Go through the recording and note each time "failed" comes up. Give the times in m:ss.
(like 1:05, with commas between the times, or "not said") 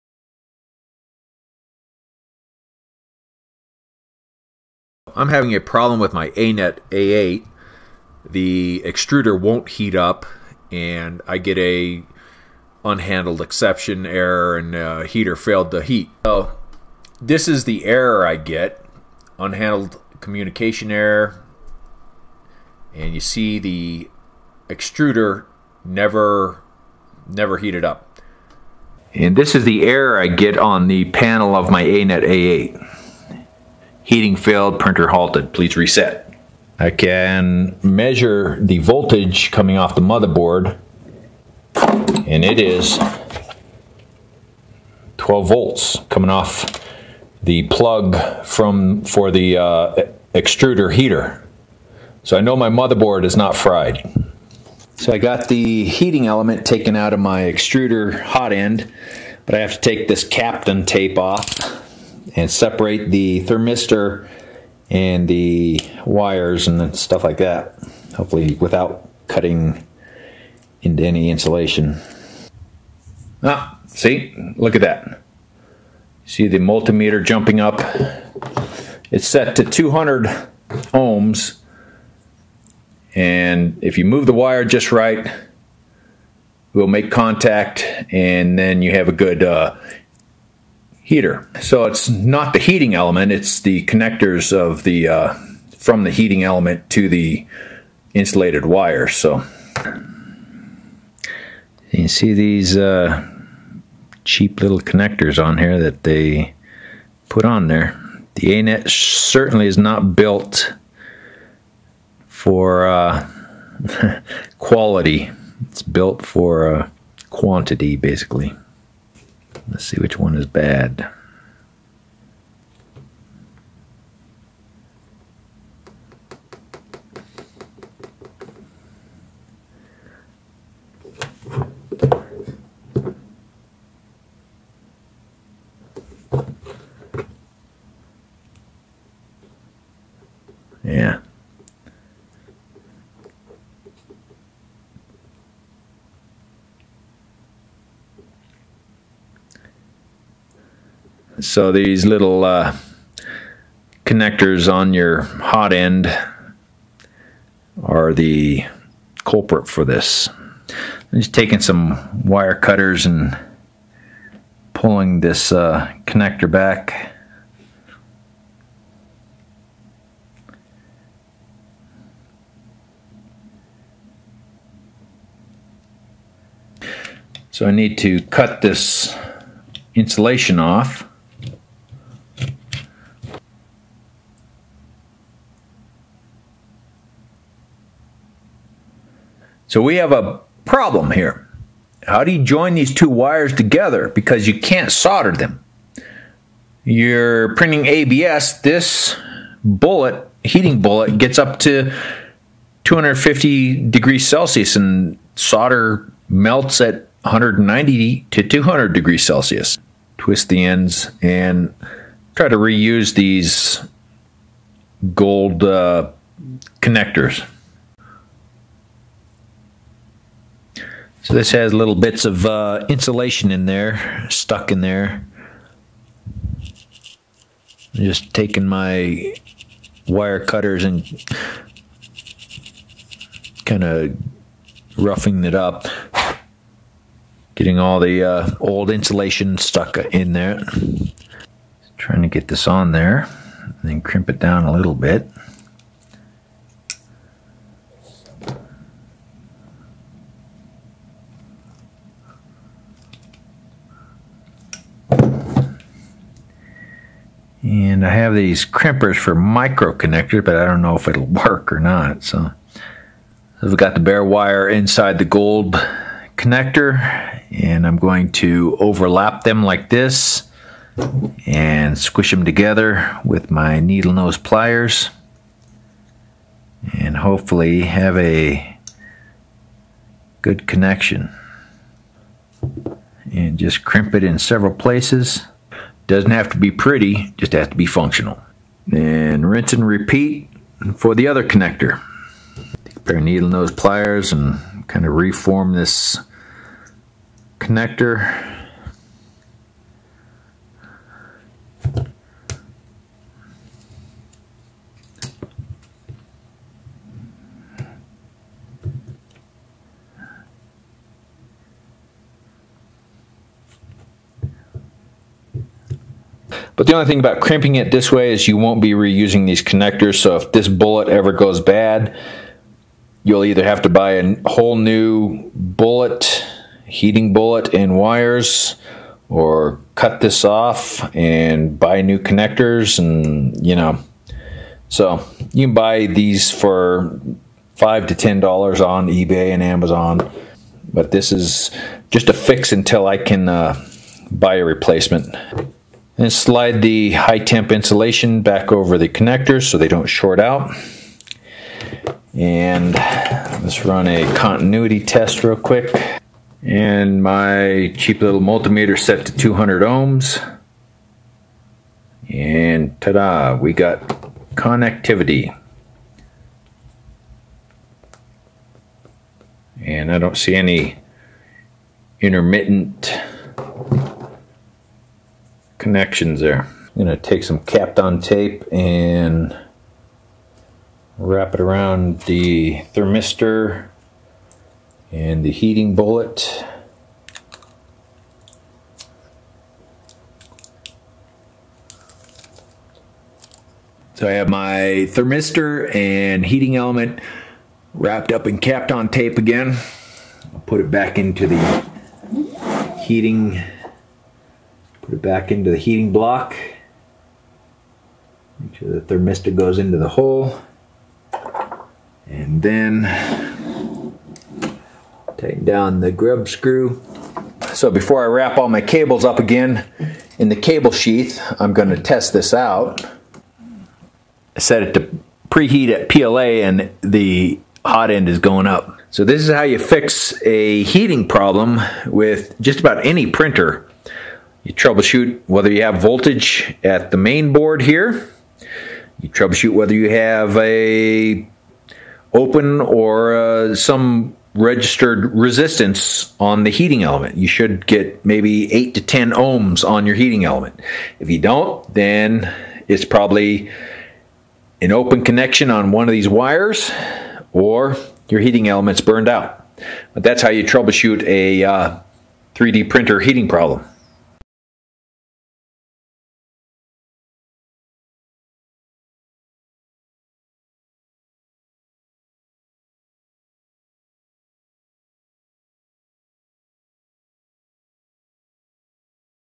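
0:15, 0:34.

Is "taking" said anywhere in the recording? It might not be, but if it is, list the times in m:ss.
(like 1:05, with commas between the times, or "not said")
2:41, 3:48.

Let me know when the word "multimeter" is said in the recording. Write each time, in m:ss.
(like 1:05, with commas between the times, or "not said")
1:16, 5:58.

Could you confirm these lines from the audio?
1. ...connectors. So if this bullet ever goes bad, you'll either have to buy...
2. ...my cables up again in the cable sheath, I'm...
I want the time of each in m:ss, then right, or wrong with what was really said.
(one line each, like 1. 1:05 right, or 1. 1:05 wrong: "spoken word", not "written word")
1. 5:19 right
2. 6:58 right.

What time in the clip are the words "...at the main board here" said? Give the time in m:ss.
7:16.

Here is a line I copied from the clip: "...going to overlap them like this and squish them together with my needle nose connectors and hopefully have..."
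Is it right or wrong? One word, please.
wrong.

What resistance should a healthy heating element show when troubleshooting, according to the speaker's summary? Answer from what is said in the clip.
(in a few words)
8 to 10 ohms.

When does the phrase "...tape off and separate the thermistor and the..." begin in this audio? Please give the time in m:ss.
1:00.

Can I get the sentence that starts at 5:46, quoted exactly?
Then slide the high temp insulation back over the connectors so they don't short out.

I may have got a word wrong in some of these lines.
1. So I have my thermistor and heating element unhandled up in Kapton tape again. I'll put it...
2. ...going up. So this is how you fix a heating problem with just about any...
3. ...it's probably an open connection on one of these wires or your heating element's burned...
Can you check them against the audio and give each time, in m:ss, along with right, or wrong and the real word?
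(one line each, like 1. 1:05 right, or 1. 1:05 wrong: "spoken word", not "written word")
1. 6:34 wrong: "wrapped", not "unhandled"
2. 7:08 right
3. 7:32 right.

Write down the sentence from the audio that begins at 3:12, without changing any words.
How do you join these two wires together?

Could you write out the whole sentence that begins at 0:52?
So I know my motherboard is not fried.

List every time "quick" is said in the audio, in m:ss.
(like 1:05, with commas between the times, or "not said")
5:55.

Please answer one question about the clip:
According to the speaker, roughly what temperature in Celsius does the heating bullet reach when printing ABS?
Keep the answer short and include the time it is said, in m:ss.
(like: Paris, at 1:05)
250 degrees Celsius, at 3:22.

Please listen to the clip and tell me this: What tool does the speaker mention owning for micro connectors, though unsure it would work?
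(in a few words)
crimpers.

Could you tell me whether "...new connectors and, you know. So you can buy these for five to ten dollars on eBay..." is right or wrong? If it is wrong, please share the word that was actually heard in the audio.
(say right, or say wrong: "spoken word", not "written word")
right.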